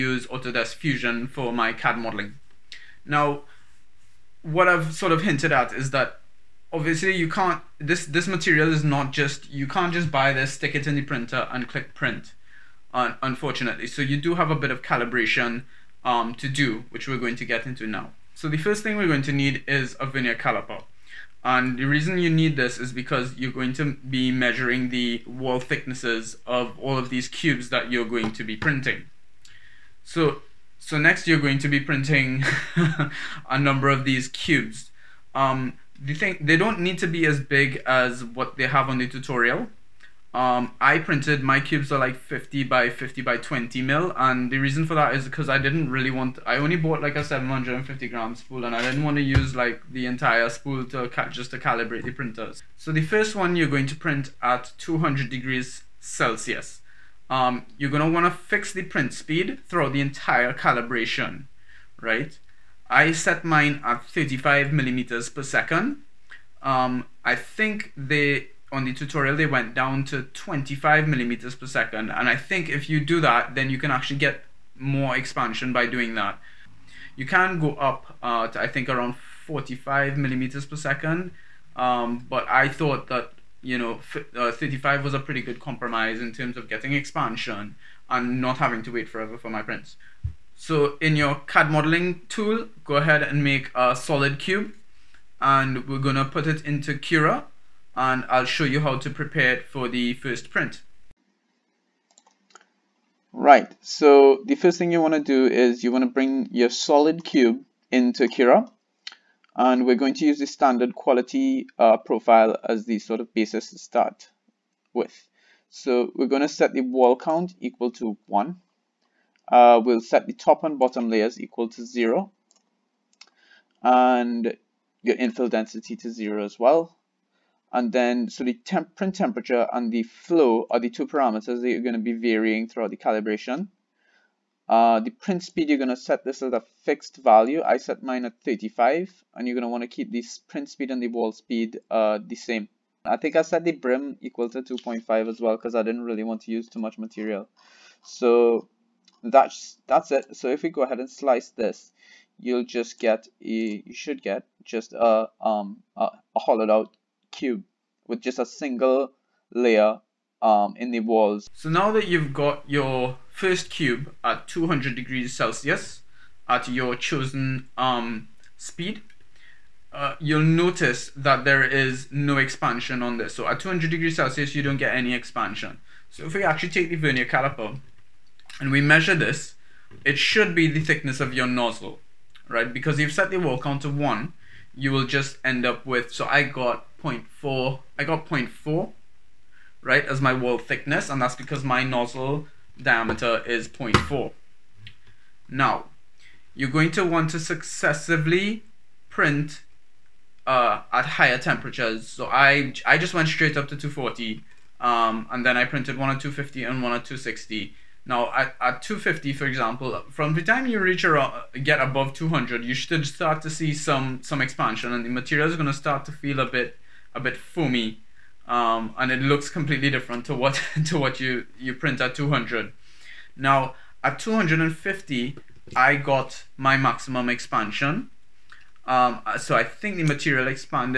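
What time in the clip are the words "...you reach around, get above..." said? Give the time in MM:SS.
03:30.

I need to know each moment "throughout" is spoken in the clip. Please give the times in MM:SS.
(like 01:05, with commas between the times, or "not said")
00:59, 02:12.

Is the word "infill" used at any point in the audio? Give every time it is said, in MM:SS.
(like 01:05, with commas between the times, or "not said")
02:05.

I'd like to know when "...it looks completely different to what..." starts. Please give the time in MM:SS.
03:39.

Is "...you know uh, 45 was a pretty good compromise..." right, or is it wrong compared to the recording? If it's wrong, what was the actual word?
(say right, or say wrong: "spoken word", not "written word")
wrong: "35", not "45".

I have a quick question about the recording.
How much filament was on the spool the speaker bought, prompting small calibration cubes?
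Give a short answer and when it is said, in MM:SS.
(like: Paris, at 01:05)
750 grams, at 00:47.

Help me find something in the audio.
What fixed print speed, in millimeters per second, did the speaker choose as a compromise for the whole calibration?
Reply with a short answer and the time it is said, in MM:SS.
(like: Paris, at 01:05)
35, at 01:04.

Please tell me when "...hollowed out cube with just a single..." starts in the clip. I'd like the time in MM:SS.
02:36.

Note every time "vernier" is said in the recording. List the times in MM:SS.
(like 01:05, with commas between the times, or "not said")
00:20, 02:56.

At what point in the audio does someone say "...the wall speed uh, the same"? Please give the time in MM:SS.
02:21.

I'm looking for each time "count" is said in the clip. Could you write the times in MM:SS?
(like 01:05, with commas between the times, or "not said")
01:57, 03:03.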